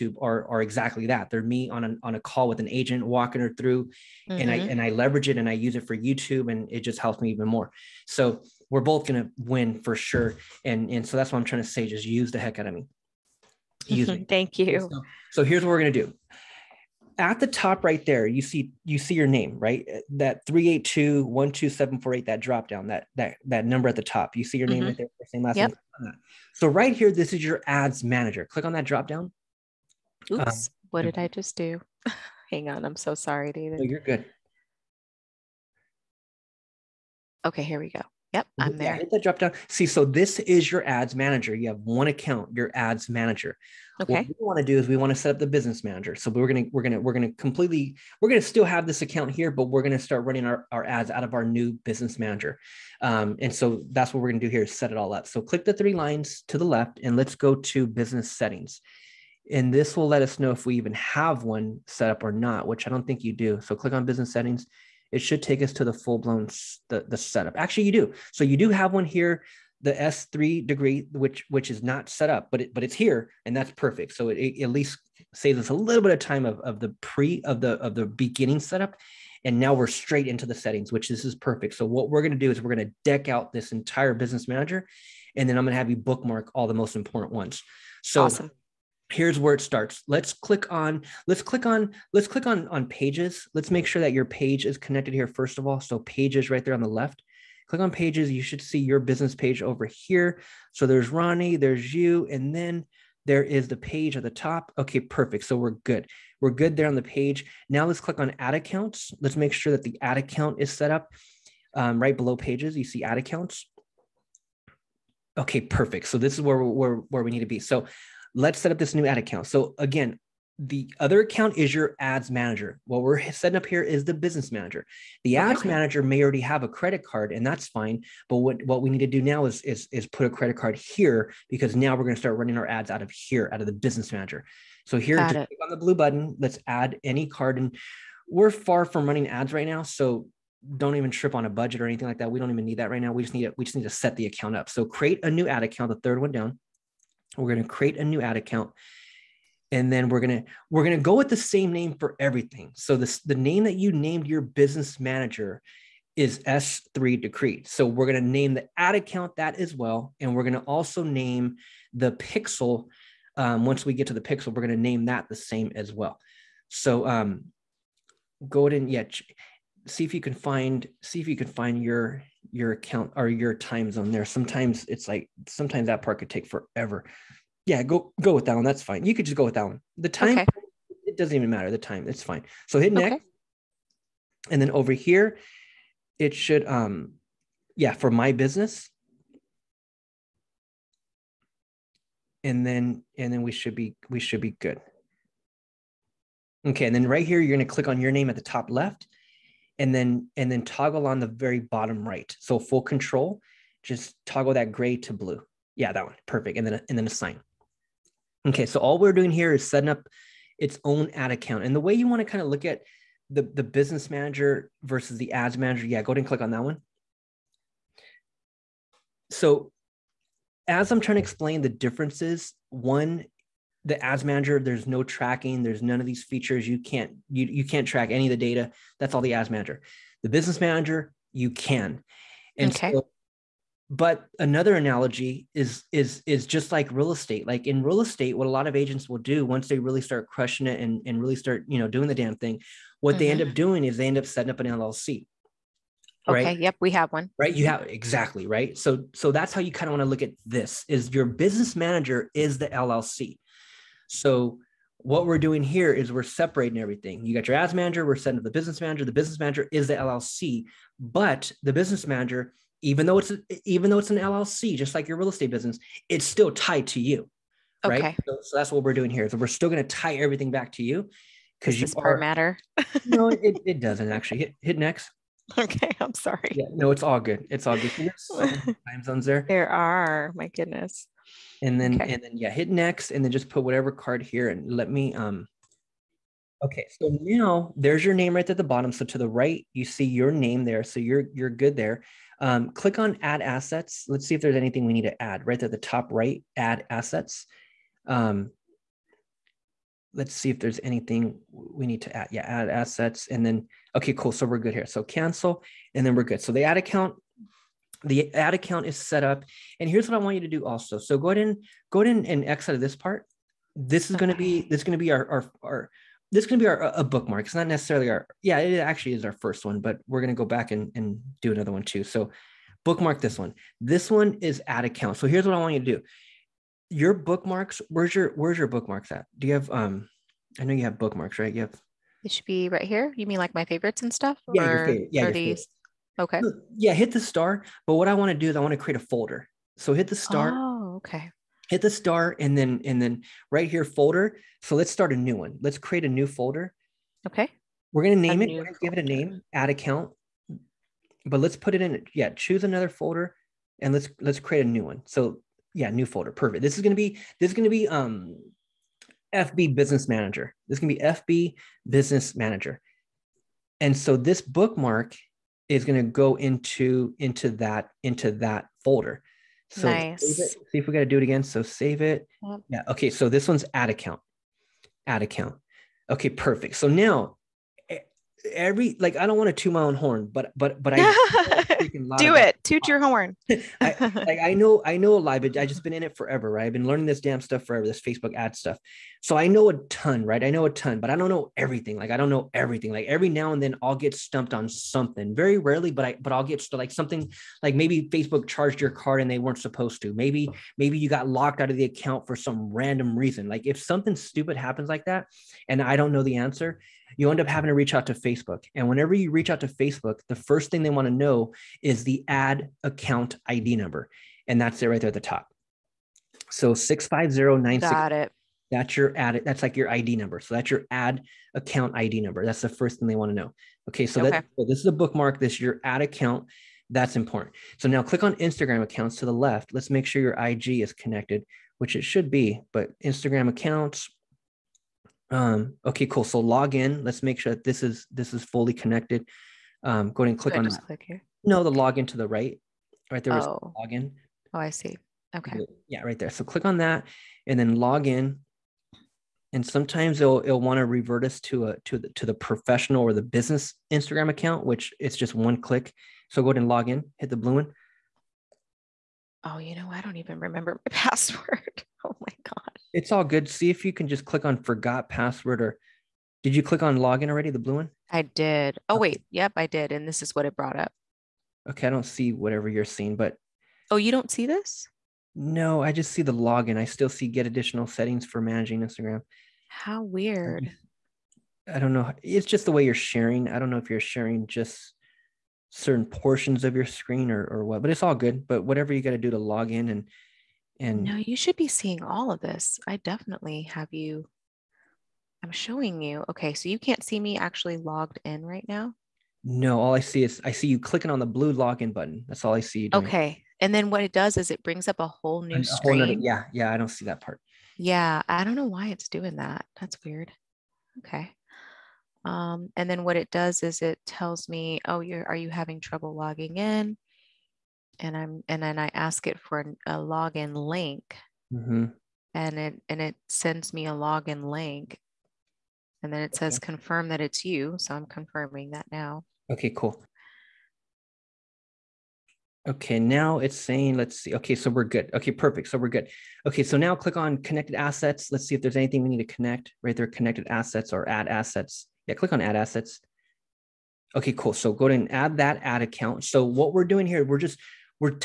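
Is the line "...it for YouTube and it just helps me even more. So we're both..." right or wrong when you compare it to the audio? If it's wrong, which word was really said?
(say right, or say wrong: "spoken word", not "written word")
right.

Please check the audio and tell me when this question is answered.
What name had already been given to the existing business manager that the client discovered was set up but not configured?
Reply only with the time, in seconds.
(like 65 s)
156 s.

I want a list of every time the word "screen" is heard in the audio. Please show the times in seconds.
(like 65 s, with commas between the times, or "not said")
486 s, 505 s.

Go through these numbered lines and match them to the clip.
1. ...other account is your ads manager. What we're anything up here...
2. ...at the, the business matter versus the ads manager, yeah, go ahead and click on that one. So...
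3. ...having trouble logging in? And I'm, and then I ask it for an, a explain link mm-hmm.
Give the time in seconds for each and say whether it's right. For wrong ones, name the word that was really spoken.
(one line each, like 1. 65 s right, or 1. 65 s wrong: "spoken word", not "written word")
1. 120 s wrong: "setting", not "anything"
2. 212 s wrong: "manager", not "matter"
3. 515 s wrong: "login", not "explain".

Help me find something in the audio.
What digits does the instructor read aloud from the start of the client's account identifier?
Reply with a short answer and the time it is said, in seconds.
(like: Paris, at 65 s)
65096, at 416 s.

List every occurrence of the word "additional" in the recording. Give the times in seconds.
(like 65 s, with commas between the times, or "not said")
477 s.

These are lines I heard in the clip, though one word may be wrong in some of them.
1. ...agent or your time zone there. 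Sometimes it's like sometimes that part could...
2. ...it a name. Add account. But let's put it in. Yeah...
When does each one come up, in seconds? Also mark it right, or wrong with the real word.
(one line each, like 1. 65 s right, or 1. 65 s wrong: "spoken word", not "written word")
1. 172 s wrong: "account", not "agent"
2. 348 s right.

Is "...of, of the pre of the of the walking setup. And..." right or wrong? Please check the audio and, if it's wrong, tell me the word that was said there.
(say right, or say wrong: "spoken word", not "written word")
wrong: "beginning", not "walking".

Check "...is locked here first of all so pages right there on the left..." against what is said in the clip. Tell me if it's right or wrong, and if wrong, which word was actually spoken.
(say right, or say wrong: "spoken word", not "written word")
wrong: "connected", not "locked".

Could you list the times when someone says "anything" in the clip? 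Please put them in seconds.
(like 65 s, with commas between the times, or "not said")
141 s, 294 s, 300 s, 538 s.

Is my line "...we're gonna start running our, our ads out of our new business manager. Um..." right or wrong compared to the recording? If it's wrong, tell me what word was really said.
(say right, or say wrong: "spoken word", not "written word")
right.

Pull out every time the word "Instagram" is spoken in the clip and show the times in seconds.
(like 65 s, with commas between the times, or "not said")
428 s, 433 s, 453 s, 478 s.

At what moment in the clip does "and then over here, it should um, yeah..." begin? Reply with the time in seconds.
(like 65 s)
184 s.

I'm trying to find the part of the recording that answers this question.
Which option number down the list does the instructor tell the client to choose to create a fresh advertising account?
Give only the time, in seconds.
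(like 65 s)
145 s.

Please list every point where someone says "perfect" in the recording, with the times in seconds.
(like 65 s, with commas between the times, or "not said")
73 s, 81 s, 104 s, 115 s, 206 s, 356 s, 376 s, 535 s.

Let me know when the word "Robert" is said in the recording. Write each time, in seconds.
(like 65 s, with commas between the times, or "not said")
not said.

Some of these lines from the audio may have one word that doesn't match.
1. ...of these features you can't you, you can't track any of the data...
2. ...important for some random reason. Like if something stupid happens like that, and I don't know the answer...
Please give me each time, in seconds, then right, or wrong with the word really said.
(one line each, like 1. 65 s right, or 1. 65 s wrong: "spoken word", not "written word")
1. 225 s right
2. 401 s wrong: "account", not "important".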